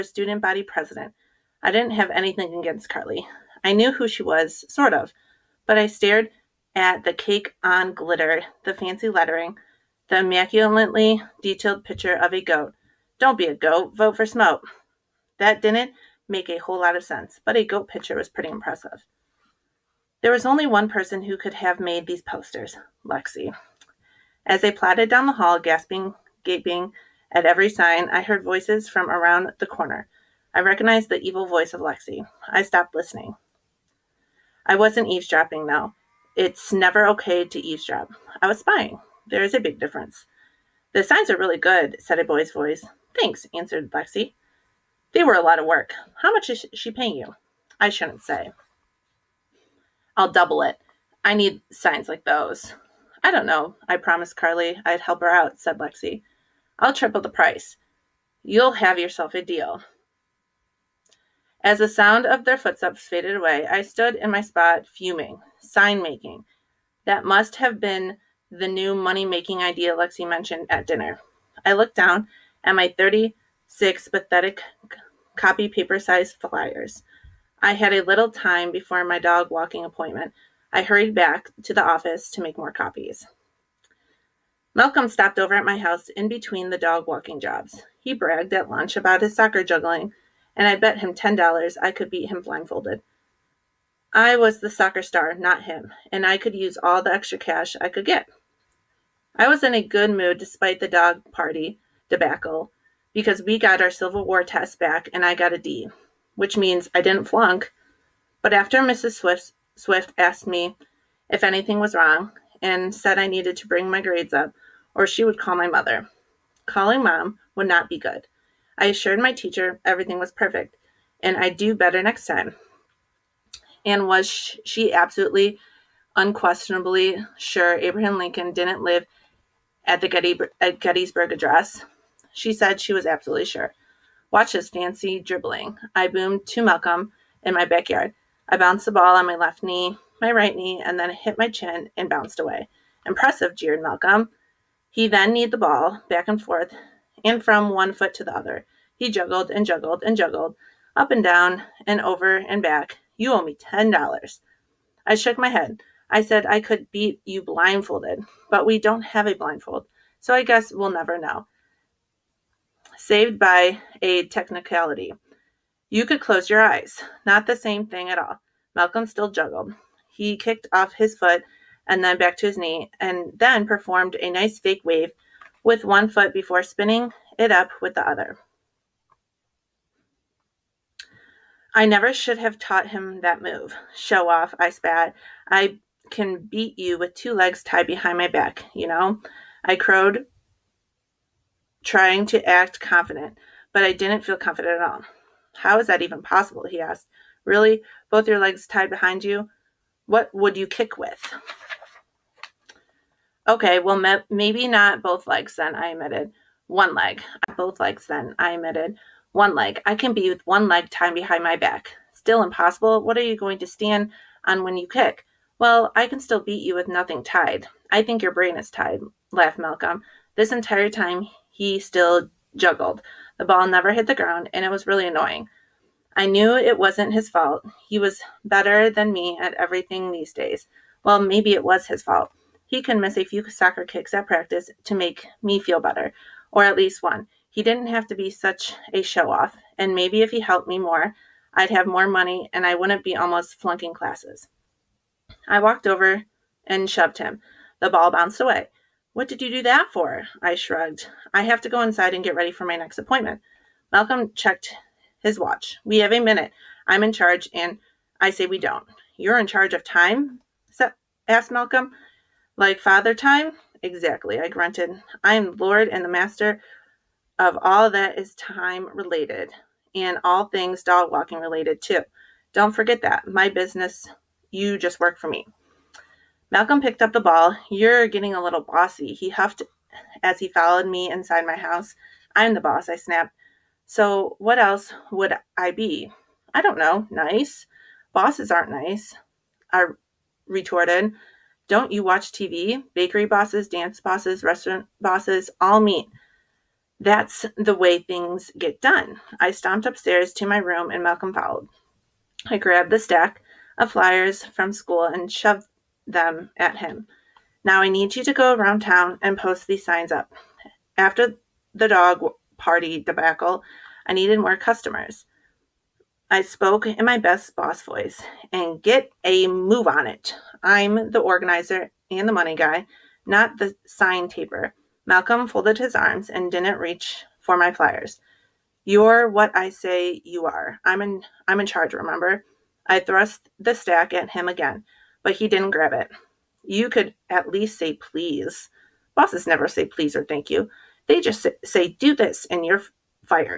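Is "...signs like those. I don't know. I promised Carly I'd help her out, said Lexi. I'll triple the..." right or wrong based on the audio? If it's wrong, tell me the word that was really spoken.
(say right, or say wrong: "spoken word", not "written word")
right.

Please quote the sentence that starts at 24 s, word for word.
As I plodded down the hall, gasping, gaping at every sign, I heard voices from around the corner.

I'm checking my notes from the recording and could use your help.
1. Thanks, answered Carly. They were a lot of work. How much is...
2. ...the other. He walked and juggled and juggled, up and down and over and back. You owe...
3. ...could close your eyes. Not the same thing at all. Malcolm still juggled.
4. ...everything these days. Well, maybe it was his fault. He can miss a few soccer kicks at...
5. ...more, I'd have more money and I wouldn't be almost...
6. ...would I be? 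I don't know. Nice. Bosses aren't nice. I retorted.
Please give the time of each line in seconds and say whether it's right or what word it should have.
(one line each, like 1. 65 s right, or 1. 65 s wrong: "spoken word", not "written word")
1. 43 s wrong: "Lexi", not "Carly"
2. 148 s wrong: "juggled", not "walked"
3. 166 s right
4. 229 s right
5. 240 s right
6. 285 s right.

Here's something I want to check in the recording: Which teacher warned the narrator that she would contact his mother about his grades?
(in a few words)
Mrs. Swift.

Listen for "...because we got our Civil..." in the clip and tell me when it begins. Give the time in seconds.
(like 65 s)
103 s.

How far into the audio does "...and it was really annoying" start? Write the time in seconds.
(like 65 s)
224 s.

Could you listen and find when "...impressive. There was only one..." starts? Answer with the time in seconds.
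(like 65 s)
18 s.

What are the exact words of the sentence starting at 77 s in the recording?
I had a little time before my dog walking appointment, I hurried back to the office to make more copies.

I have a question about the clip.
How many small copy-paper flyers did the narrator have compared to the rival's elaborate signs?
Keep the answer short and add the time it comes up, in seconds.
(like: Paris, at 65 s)
36, at 72 s.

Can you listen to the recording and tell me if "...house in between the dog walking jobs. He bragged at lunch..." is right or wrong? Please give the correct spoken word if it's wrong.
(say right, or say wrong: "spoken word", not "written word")
right.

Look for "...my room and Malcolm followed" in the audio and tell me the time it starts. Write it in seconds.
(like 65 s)
300 s.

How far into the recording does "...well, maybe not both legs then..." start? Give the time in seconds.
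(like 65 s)
203 s.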